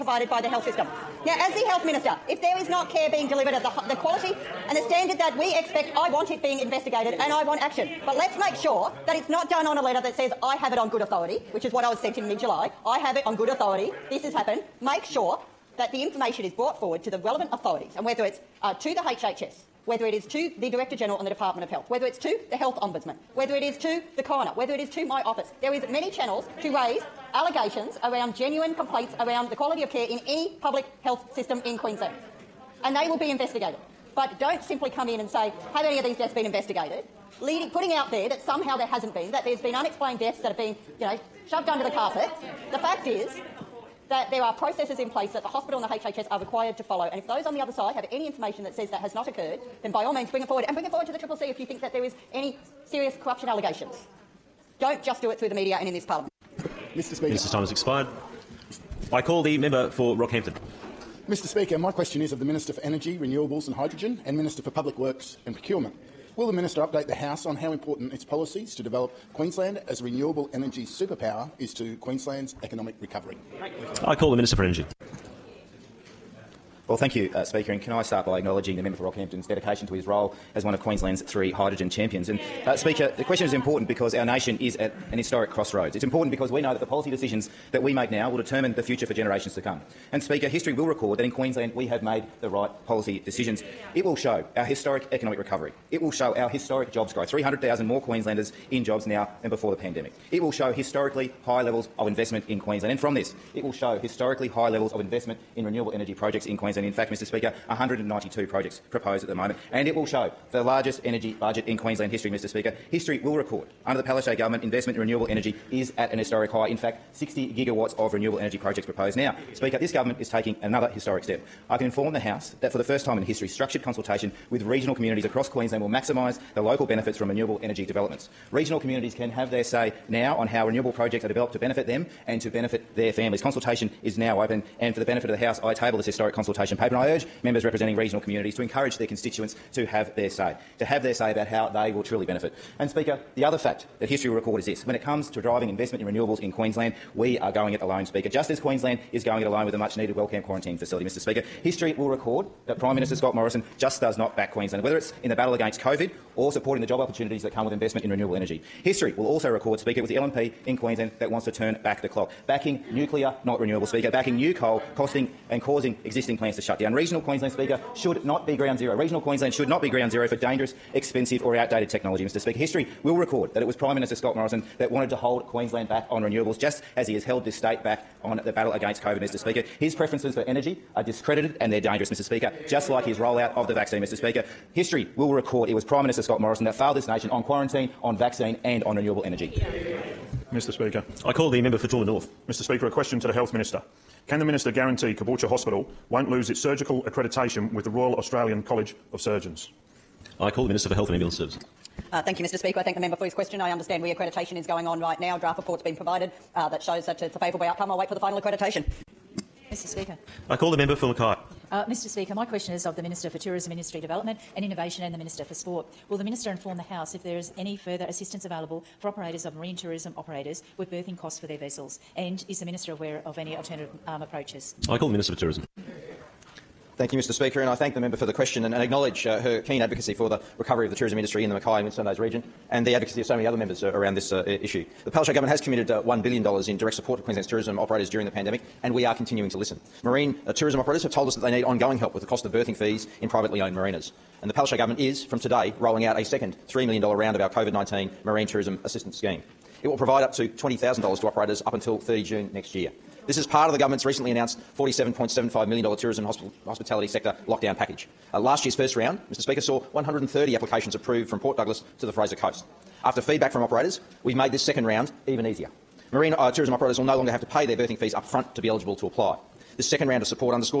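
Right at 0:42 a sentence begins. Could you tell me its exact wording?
The fact is that there are processes in place that the hospital and the HHS are required to follow.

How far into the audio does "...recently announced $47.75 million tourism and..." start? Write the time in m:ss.
4:14.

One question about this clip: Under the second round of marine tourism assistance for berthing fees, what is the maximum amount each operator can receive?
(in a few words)
$20,000.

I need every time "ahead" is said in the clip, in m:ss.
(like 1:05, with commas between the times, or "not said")
not said.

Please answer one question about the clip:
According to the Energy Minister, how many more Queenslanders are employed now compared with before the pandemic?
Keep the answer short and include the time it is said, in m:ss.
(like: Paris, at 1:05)
300,000, at 1:37.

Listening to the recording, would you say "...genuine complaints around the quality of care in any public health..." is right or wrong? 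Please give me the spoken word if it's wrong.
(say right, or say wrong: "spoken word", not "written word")
right.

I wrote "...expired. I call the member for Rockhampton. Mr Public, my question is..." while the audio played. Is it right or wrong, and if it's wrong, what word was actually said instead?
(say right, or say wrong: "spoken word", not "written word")
wrong: "Speaker", not "Public".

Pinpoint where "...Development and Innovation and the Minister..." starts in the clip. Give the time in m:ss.
3:33.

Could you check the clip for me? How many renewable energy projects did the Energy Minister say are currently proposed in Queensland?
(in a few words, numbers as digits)
192.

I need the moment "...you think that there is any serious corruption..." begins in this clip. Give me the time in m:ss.
0:51.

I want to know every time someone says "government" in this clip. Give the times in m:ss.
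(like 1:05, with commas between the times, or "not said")
1:54, 1:59, 3:55, 4:04, 4:13.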